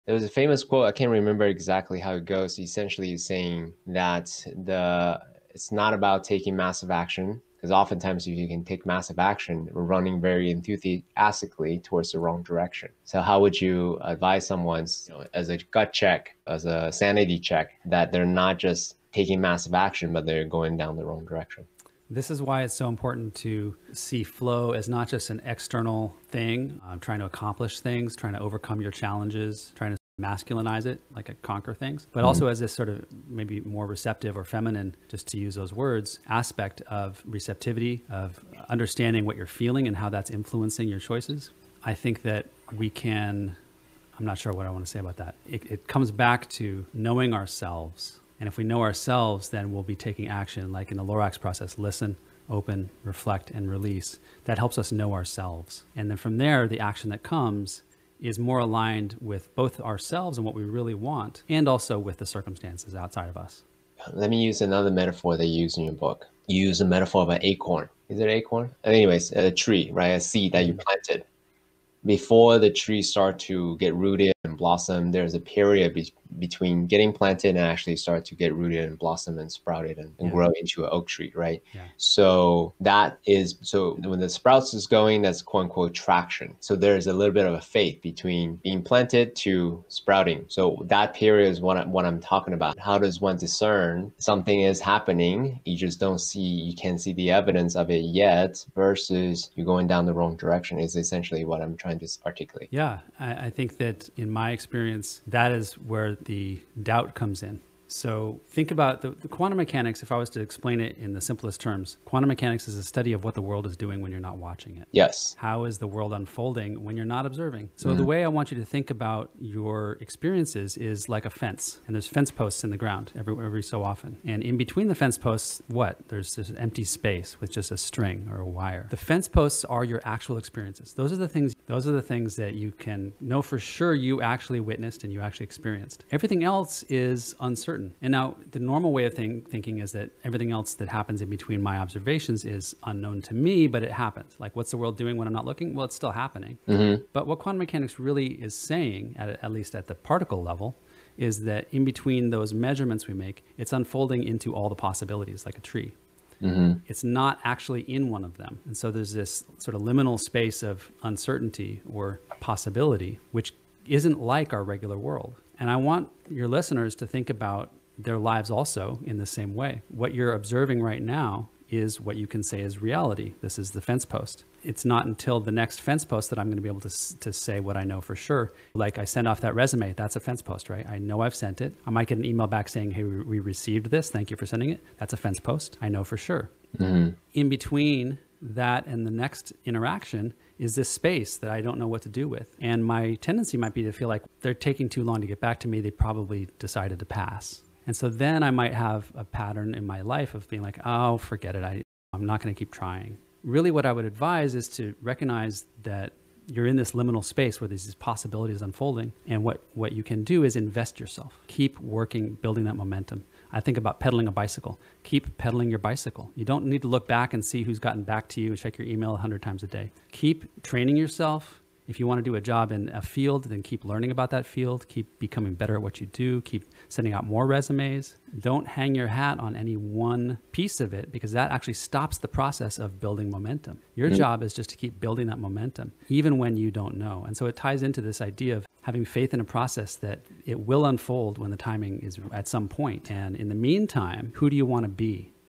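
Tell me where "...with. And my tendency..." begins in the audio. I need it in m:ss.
3:12.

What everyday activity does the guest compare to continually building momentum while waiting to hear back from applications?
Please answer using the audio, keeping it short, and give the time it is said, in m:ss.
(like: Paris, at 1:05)
Pedaling a bicycle, at 3:34.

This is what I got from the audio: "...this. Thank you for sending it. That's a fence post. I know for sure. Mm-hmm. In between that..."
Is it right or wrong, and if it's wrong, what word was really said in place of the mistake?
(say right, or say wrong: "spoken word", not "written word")
right.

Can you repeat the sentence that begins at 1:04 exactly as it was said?
Let me use another metaphor they use in your book.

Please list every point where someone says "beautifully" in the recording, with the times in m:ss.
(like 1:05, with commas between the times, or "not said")
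not said.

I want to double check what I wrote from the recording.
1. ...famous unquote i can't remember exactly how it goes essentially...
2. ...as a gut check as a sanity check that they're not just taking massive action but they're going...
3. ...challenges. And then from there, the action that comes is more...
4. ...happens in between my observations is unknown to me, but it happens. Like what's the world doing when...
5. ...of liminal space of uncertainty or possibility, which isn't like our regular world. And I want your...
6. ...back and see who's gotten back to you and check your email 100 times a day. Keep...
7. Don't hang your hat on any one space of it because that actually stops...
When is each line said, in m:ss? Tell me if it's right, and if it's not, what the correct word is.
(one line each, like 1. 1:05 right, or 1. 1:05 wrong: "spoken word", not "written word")
1. 0:00 wrong: "quote", not "unquote"
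2. 0:15 right
3. 0:55 wrong: "ourselves", not "challenges"
4. 2:20 right
5. 2:39 right
6. 3:37 right
7. 3:48 wrong: "piece", not "space".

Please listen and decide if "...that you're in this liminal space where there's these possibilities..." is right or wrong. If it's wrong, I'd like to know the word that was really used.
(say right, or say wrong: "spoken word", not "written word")
right.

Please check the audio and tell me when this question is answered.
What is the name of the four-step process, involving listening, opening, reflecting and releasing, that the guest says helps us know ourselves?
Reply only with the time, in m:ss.
0:51.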